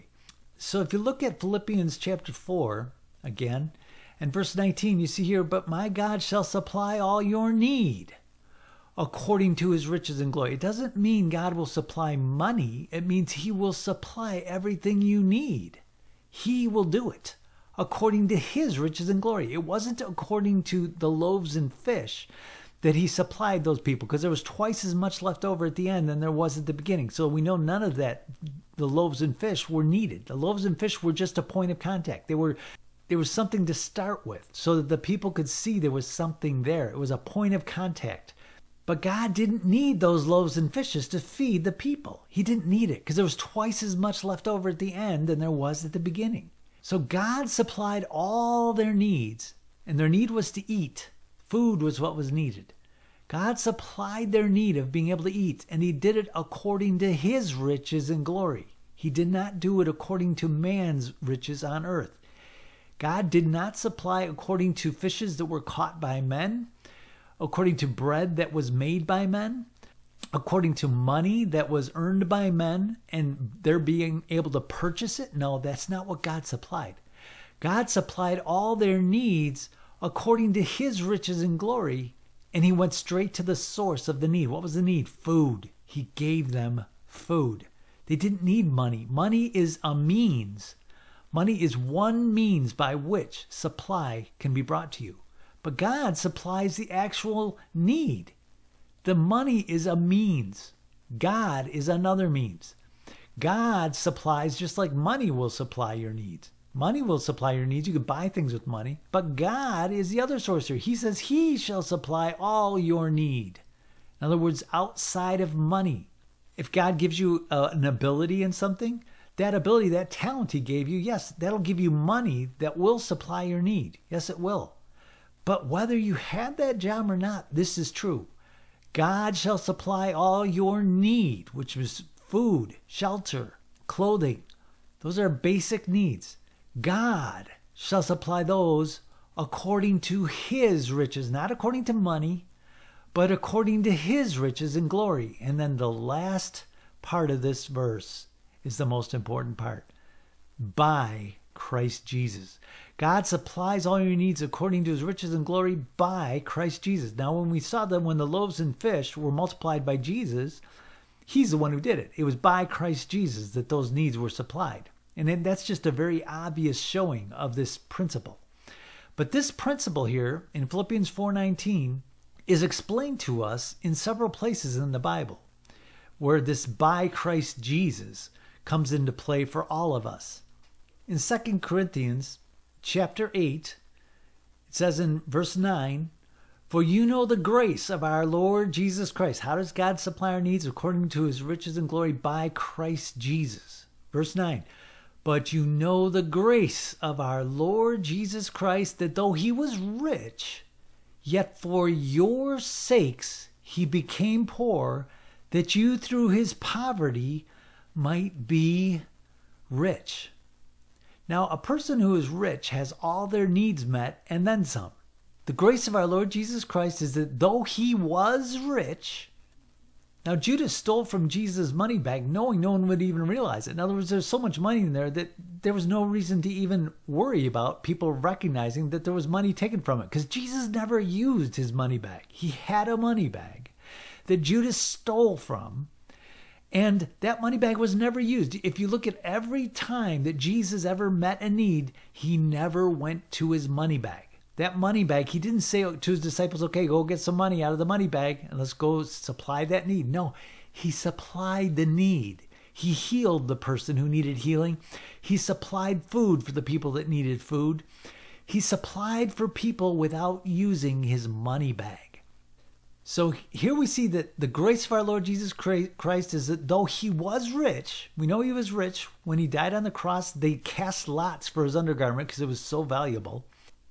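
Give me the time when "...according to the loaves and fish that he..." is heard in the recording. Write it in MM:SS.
00:20.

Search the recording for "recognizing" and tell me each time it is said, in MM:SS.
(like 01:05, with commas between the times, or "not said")
03:48.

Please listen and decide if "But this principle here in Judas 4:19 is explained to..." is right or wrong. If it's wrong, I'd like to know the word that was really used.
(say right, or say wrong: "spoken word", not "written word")
wrong: "Philippians", not "Judas".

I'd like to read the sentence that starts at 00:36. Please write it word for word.
It was a point of contact.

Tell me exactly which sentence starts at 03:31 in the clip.
Now, a person who is rich has all their needs met and then some.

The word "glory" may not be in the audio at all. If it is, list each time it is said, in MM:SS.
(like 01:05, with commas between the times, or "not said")
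00:10, 00:19, 00:58, 01:21, 02:24, 02:35, 03:11.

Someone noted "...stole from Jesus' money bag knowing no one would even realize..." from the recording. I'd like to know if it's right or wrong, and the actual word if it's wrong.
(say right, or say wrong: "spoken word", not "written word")
right.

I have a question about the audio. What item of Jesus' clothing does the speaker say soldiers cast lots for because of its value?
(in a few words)
His undergarment.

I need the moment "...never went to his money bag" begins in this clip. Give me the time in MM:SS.
04:02.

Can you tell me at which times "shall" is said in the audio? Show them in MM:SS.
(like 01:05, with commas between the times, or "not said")
00:06, 01:51, 02:09, 02:17.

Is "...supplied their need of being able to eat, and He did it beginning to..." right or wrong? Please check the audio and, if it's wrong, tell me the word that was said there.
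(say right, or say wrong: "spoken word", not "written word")
wrong: "according", not "beginning".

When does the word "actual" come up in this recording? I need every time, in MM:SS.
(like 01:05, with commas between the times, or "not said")
01:36.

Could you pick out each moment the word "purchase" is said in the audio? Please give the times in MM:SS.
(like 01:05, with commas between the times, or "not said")
01:14.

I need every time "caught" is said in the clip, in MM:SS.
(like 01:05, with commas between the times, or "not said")
01:05.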